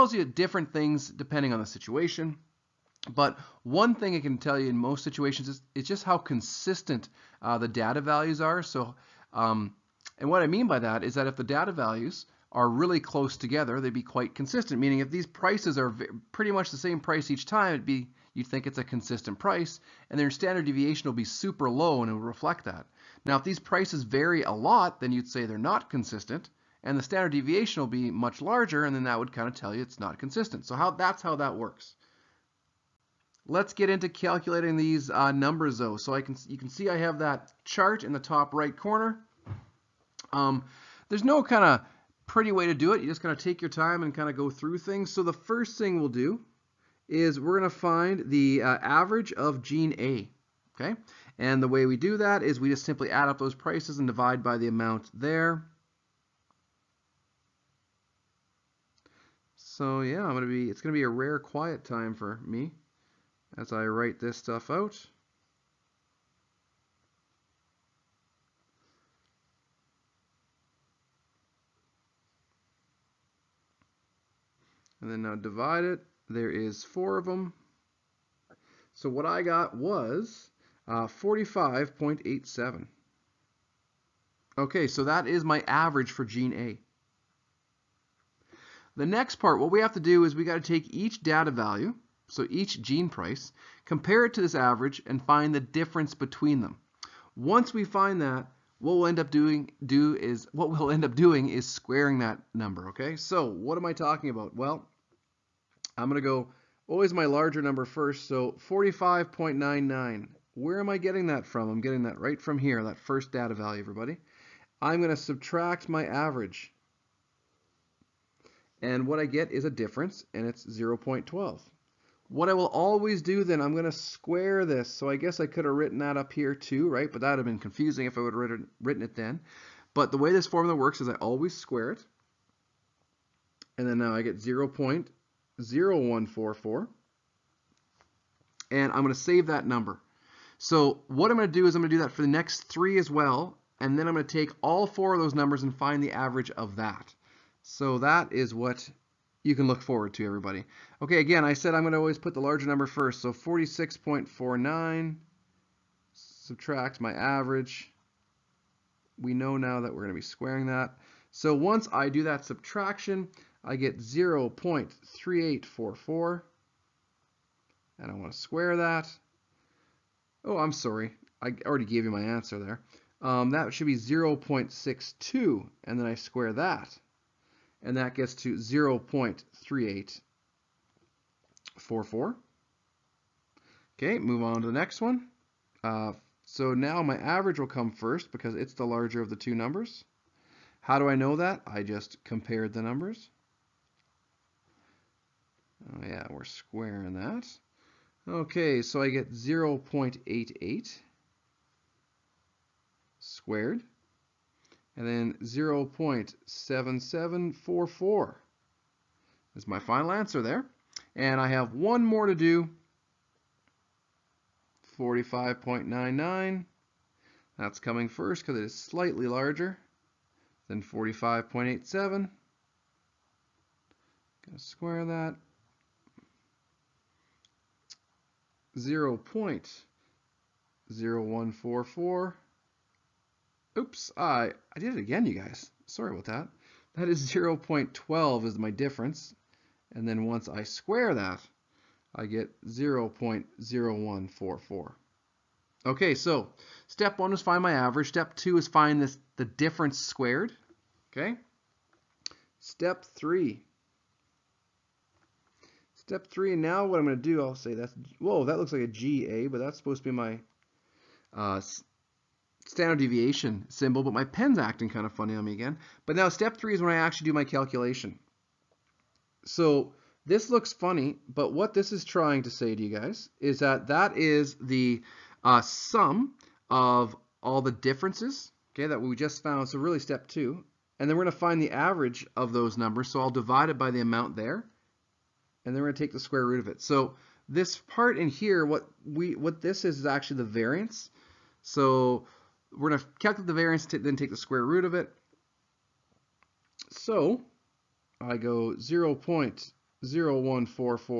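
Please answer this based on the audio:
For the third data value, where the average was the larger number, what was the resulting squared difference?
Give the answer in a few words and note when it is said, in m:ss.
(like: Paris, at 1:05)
0.7744, at 3:25.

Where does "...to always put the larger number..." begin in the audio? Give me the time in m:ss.
2:31.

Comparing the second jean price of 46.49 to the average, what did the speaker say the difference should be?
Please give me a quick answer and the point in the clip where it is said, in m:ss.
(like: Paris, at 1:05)
0.62, at 2:53.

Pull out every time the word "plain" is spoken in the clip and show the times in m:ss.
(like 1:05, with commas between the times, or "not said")
not said.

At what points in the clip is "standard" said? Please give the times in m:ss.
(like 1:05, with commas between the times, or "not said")
0:20, 0:27, 4:22.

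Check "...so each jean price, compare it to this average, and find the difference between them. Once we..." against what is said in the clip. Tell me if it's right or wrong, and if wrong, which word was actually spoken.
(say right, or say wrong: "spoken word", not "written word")
right.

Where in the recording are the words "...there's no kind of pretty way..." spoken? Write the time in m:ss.
0:41.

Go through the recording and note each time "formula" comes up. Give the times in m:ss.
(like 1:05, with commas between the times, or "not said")
2:10.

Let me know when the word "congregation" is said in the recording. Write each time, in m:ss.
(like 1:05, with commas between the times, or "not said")
not said.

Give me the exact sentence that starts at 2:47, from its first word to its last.
And I want to square that.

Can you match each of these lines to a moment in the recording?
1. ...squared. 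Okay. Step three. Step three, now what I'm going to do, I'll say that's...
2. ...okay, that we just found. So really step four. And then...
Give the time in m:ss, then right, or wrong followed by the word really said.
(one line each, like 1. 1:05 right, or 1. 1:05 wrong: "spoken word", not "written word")
1. 4:09 right
2. 4:38 wrong: "two", not "four".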